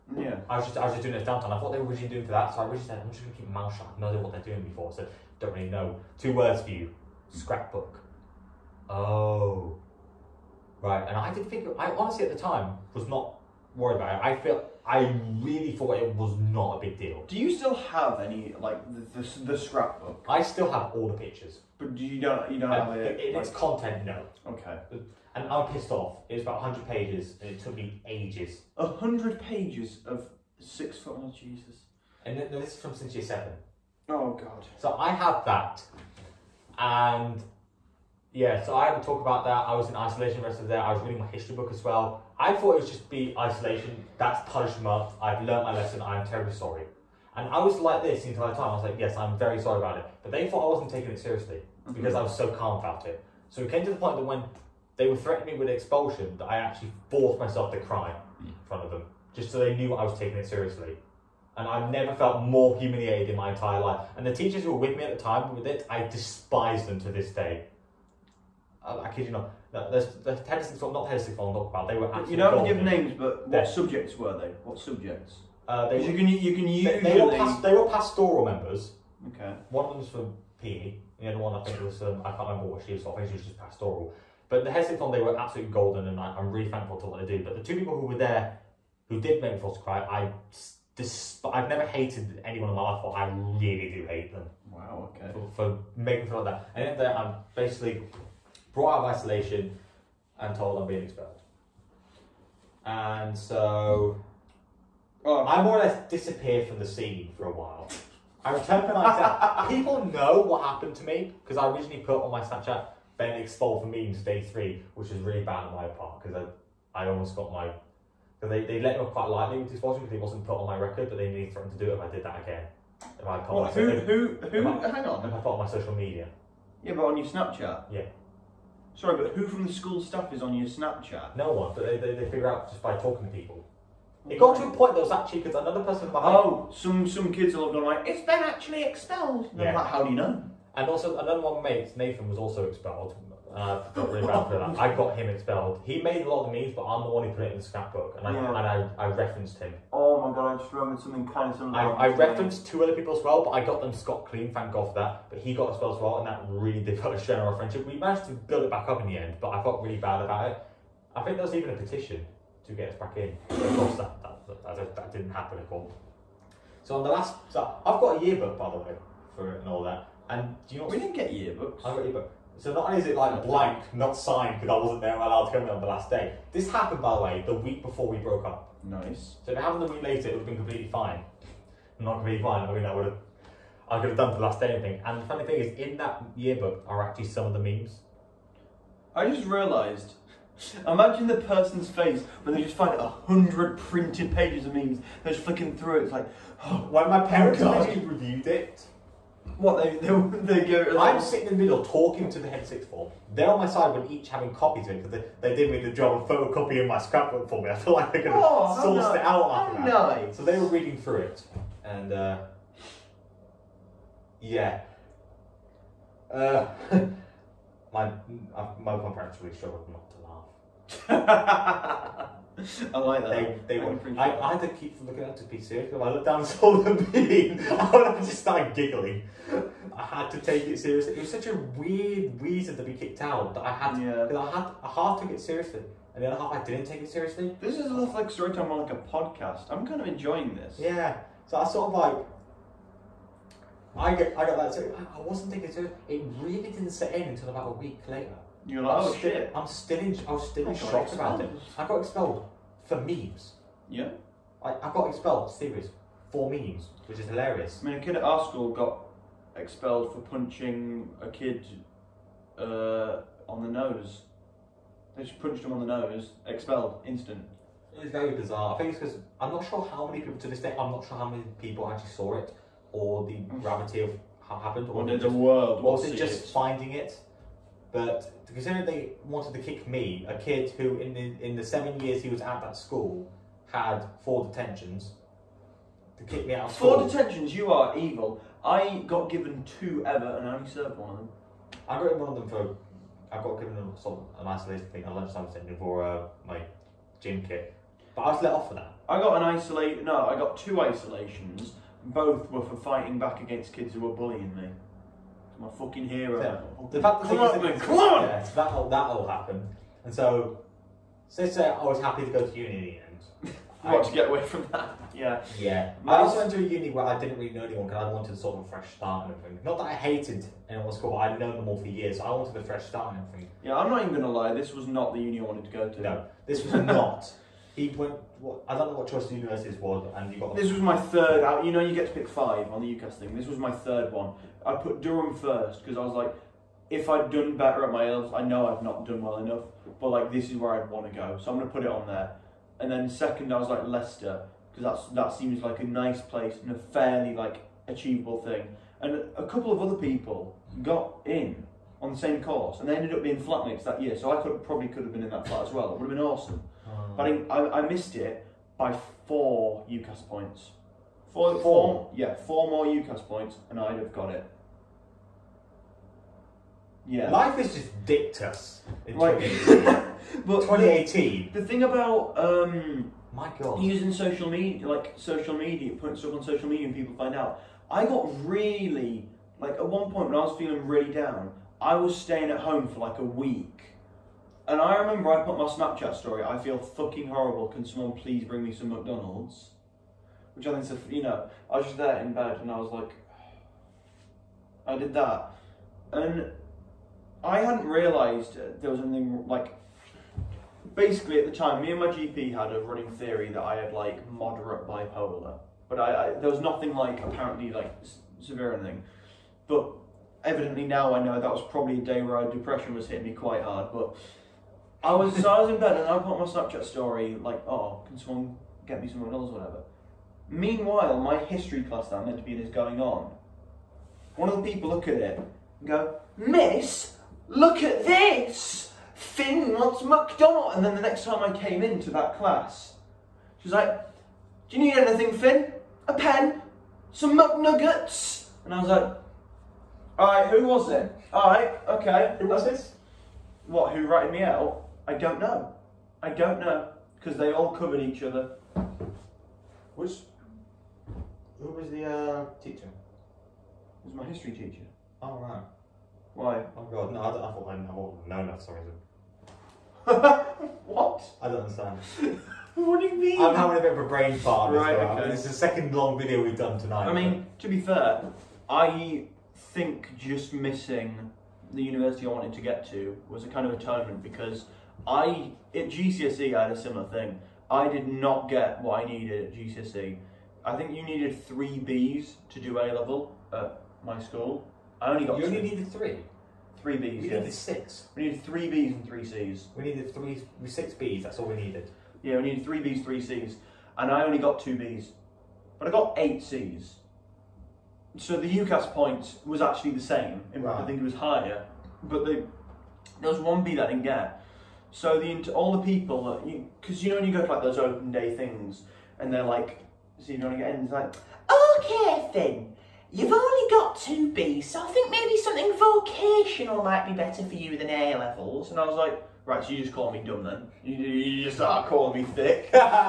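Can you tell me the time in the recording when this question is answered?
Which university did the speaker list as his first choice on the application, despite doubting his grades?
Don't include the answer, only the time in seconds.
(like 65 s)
335 s.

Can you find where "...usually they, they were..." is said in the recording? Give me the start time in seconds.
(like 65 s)
76 s.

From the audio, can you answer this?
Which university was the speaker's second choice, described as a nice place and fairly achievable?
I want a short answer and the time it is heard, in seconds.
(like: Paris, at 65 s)
Leicester, at 343 s.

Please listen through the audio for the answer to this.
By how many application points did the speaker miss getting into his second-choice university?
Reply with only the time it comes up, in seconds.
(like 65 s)
359 s.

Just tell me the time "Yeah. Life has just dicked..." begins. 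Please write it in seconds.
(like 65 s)
367 s.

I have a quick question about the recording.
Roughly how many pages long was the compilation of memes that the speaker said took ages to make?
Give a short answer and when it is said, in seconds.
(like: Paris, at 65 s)
100, at 26 s.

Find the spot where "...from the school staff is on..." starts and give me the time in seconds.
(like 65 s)
129 s.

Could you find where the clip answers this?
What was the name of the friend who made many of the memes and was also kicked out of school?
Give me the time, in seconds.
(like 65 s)
141 s.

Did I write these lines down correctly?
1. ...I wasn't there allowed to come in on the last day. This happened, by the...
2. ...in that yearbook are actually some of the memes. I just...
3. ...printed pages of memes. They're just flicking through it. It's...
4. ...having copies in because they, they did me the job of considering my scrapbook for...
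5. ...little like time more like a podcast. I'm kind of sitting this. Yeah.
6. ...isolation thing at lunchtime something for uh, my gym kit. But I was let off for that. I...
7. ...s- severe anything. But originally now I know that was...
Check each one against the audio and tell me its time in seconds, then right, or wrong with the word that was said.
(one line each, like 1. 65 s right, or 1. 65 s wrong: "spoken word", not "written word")
1. 174 s right
2. 185 s right
3. 193 s right
4. 204 s wrong: "photocopying", not "considering"
5. 237 s wrong: "enjoying", not "sitting"
6. 294 s right
7. 408 s wrong: "evidently", not "originally".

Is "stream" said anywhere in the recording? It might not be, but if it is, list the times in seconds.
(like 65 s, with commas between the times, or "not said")
not said.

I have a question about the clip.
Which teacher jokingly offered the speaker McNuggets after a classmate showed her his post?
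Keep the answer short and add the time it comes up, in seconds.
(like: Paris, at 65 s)
History teacher, at 454 s.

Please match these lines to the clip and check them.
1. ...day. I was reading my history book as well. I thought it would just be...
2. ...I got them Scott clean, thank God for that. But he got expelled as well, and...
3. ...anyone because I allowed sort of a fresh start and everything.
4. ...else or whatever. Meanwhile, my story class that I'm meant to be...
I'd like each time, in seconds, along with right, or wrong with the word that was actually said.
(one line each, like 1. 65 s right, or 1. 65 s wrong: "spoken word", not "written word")
1. 40 s right
2. 153 s right
3. 317 s wrong: "wanted", not "allowed"
4. 419 s wrong: "history", not "story".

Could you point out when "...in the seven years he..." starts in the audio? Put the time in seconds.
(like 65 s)
281 s.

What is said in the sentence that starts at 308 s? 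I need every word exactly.
Yeah, that'll, that all happened, And so, since uh, I was happy to go to uni in the end.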